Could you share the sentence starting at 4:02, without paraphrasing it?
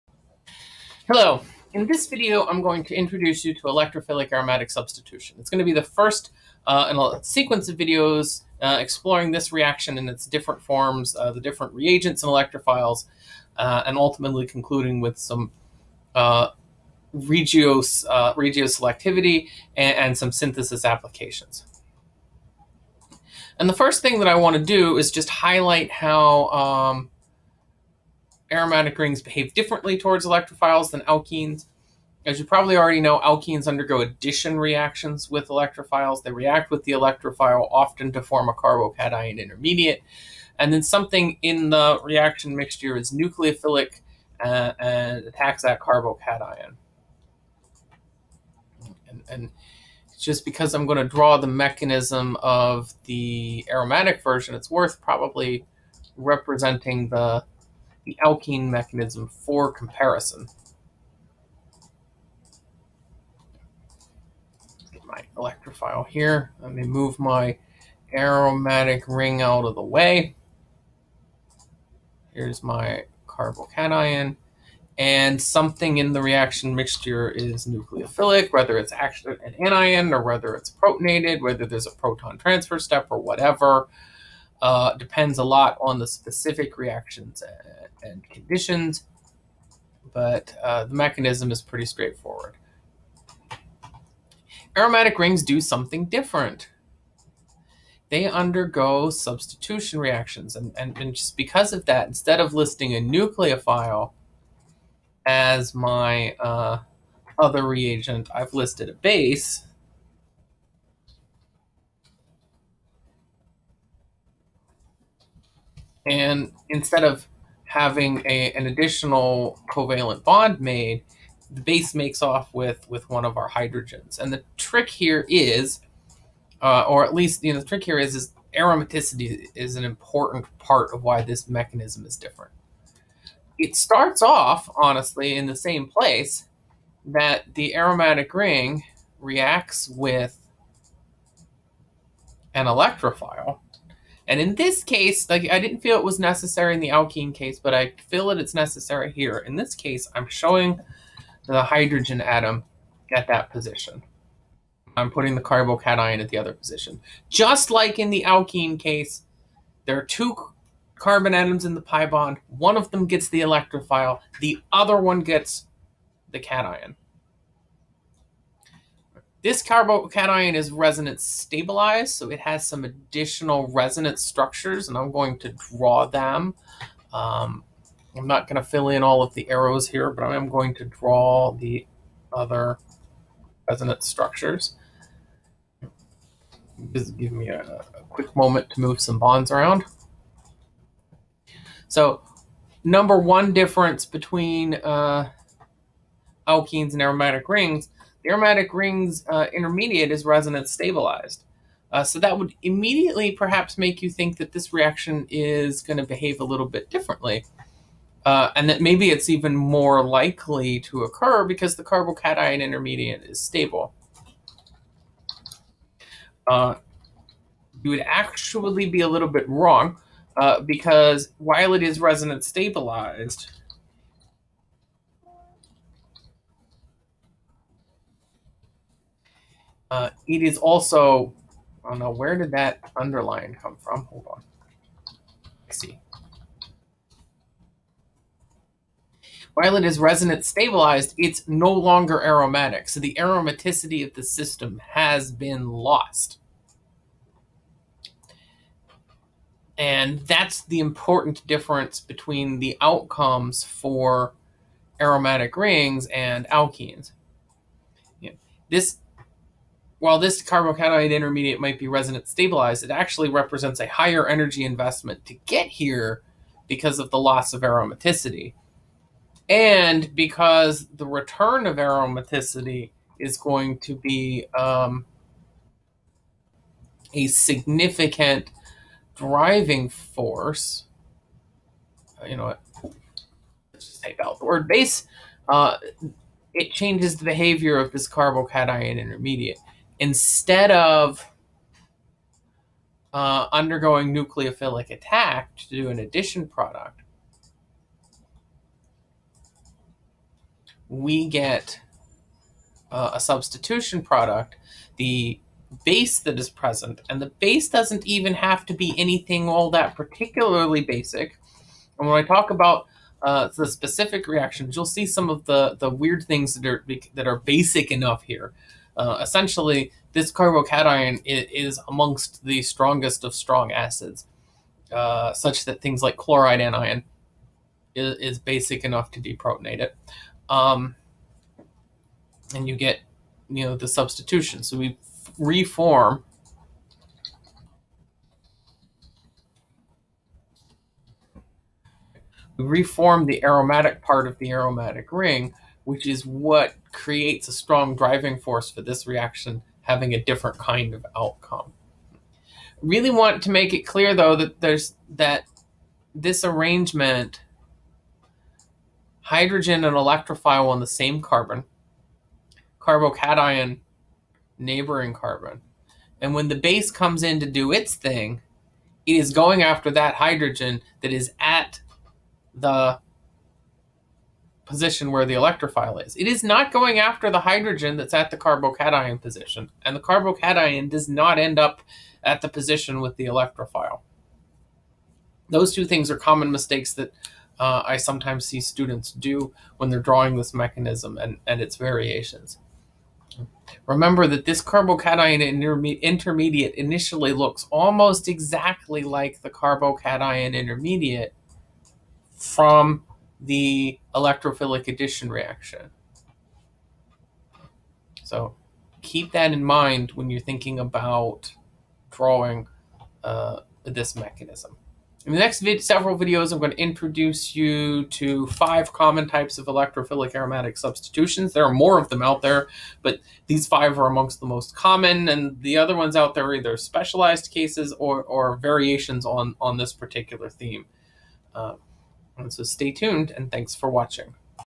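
So the aromaticity of the system has been lost.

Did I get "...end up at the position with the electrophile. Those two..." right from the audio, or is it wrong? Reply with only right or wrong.
right.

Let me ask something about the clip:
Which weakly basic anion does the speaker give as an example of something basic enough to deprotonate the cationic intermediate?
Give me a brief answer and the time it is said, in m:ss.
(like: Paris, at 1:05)
Chloride anion, at 5:26.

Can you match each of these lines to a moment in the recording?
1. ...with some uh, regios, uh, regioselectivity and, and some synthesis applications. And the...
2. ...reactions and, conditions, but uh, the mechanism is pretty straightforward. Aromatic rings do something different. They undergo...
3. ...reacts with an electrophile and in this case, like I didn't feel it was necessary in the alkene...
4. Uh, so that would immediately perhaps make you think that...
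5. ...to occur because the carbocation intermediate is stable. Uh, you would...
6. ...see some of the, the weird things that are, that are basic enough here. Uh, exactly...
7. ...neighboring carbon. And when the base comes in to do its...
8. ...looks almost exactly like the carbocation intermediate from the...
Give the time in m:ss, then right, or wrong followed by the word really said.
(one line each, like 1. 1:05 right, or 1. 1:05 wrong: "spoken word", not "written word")
1. 0:15 right
2. 1:26 right
3. 2:19 right
4. 3:21 right
5. 3:30 right
6. 5:14 wrong: "essentially", not "exactly"
7. 6:04 right
8. 6:37 right.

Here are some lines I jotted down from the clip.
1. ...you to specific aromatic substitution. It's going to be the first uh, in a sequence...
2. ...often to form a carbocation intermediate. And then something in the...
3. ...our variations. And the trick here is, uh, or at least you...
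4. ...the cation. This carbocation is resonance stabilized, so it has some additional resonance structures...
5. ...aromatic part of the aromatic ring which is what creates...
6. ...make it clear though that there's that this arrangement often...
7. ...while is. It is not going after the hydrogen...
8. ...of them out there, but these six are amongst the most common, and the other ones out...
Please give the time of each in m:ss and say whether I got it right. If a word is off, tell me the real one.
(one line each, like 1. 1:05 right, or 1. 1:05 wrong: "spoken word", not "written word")
1. 0:03 wrong: "electrophilic", not "specific"
2. 0:37 right
3. 2:03 wrong: "hydrogens", not "variations"
4. 2:46 right
5. 5:43 right
6. 5:53 wrong: "hydrogen", not "often"
7. 6:15 wrong: "electrophile", not "while"
8. 7:01 wrong: "five", not "six".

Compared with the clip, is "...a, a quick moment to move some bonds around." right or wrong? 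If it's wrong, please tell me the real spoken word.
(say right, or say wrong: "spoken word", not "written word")
right.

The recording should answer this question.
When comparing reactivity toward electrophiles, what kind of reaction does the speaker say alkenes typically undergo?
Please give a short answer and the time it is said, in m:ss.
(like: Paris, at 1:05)
Addition reactions, at 0:34.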